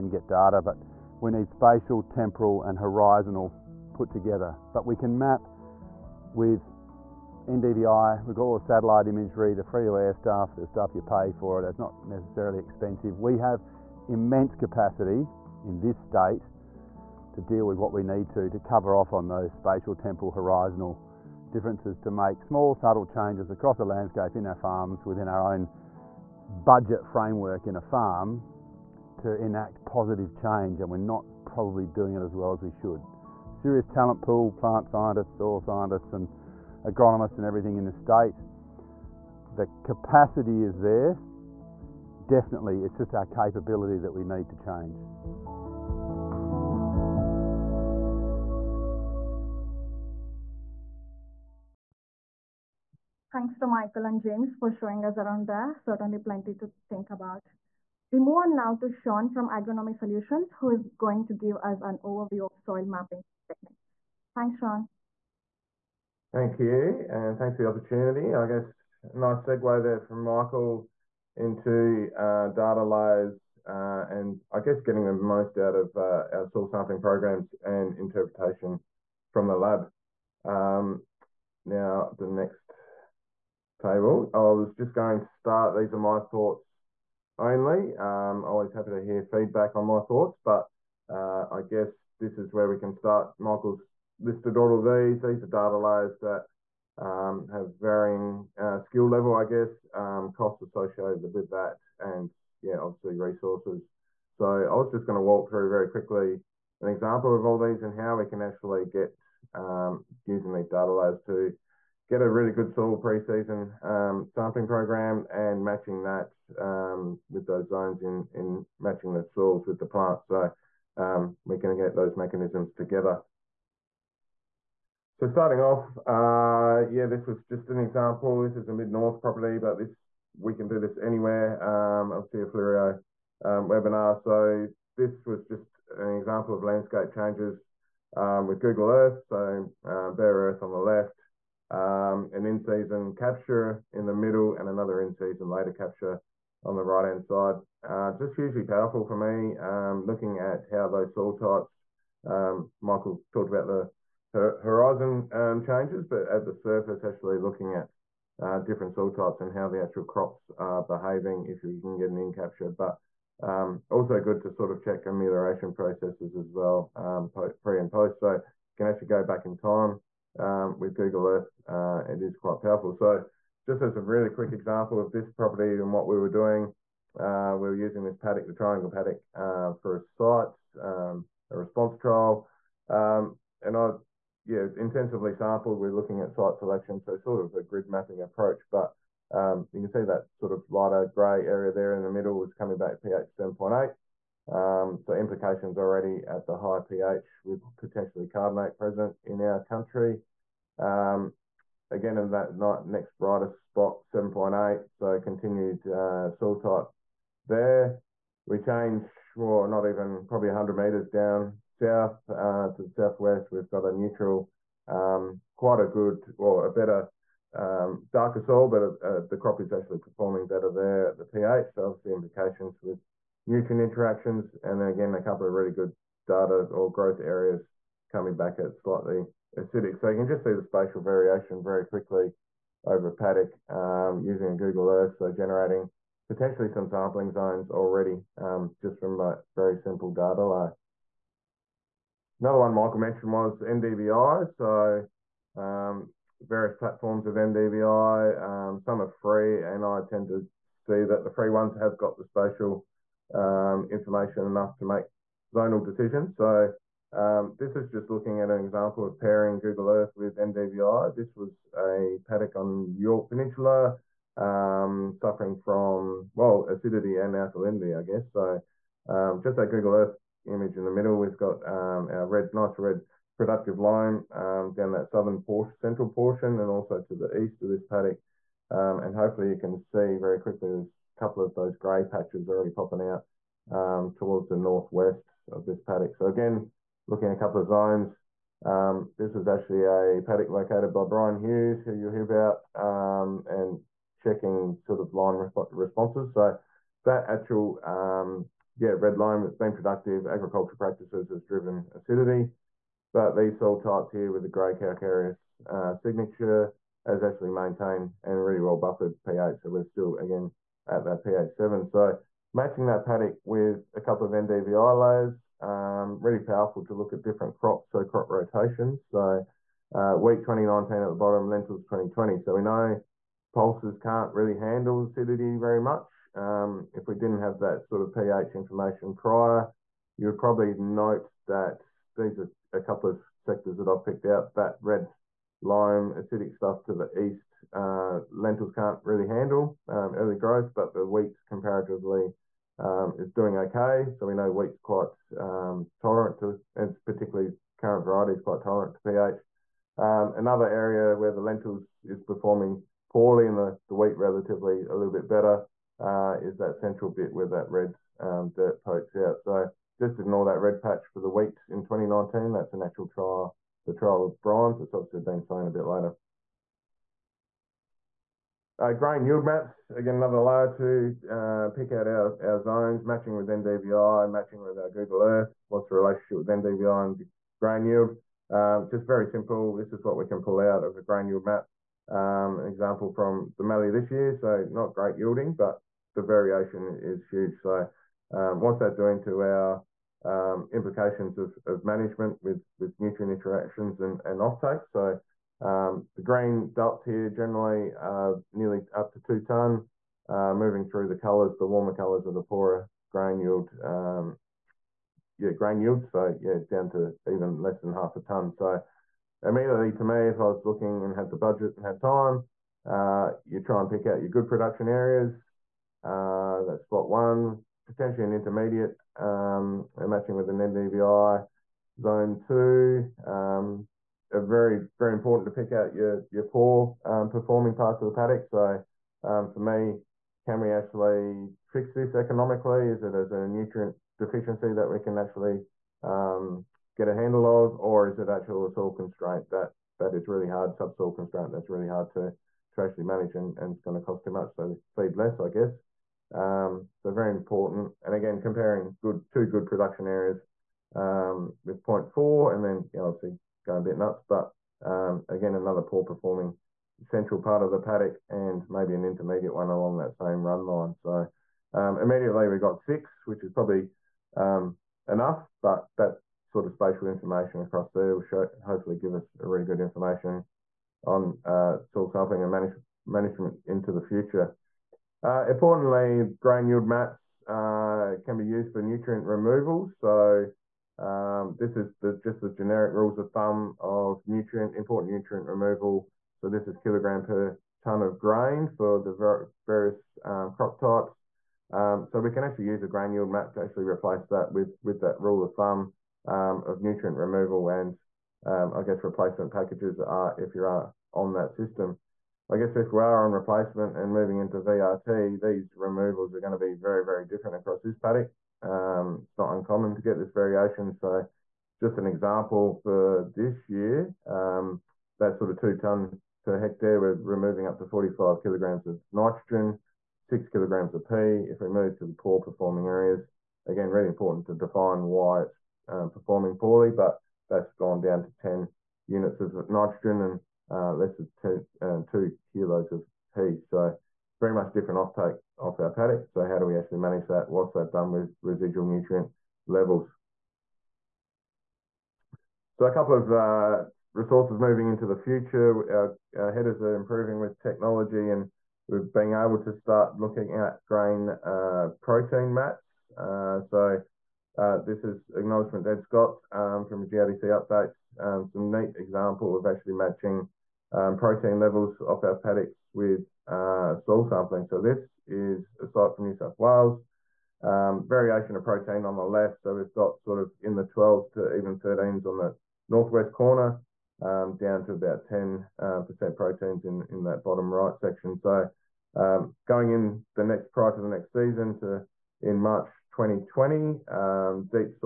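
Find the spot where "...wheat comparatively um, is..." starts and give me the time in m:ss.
5:41.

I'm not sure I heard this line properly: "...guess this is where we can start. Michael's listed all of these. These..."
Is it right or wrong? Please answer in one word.
right.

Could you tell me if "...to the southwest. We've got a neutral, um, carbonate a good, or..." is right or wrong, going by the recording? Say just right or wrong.
wrong.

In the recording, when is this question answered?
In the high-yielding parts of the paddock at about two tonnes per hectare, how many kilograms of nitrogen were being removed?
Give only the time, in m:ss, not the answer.
8:37.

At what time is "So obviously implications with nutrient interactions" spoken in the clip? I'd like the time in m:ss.
3:41.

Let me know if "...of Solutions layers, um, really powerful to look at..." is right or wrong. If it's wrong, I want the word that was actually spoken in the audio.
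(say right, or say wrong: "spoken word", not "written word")
wrong: "NDVI", not "Solutions".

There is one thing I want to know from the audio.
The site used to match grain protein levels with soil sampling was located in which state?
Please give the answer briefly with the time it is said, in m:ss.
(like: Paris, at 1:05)
New South Wales, at 9:26.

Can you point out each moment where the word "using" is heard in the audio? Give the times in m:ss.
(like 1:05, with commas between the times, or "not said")
1:50, 2:57, 3:54.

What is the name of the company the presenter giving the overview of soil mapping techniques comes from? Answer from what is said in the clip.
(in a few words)
Agronomy Solutions.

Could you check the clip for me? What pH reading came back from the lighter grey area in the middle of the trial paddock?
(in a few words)
7.8.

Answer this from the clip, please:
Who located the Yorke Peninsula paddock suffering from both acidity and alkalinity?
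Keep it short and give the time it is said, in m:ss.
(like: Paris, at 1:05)
Brian Hughes, at 4:51.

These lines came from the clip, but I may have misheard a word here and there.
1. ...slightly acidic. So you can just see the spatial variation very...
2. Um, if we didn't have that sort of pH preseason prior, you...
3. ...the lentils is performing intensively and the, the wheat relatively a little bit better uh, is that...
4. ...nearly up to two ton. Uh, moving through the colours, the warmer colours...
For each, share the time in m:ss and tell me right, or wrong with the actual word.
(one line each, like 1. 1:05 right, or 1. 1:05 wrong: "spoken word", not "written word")
1. 3:48 right
2. 5:26 wrong: "information", not "preseason"
3. 5:51 wrong: "poorly", not "intensively"
4. 6:38 right.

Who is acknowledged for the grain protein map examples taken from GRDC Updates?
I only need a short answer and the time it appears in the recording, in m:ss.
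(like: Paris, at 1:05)
Ed Scott, at 9:15.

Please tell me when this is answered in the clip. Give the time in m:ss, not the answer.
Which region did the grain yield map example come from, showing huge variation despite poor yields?
6:23.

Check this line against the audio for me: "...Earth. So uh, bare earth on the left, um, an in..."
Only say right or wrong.
right.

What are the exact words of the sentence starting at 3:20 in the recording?
Um, again, in that next brightest spot, 7.8, so continued uh, soil type there.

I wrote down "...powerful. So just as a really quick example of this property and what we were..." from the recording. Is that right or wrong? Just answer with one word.
right.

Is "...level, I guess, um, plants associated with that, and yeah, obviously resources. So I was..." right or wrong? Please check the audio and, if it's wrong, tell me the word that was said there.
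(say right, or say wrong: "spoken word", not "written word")
wrong: "costs", not "plants".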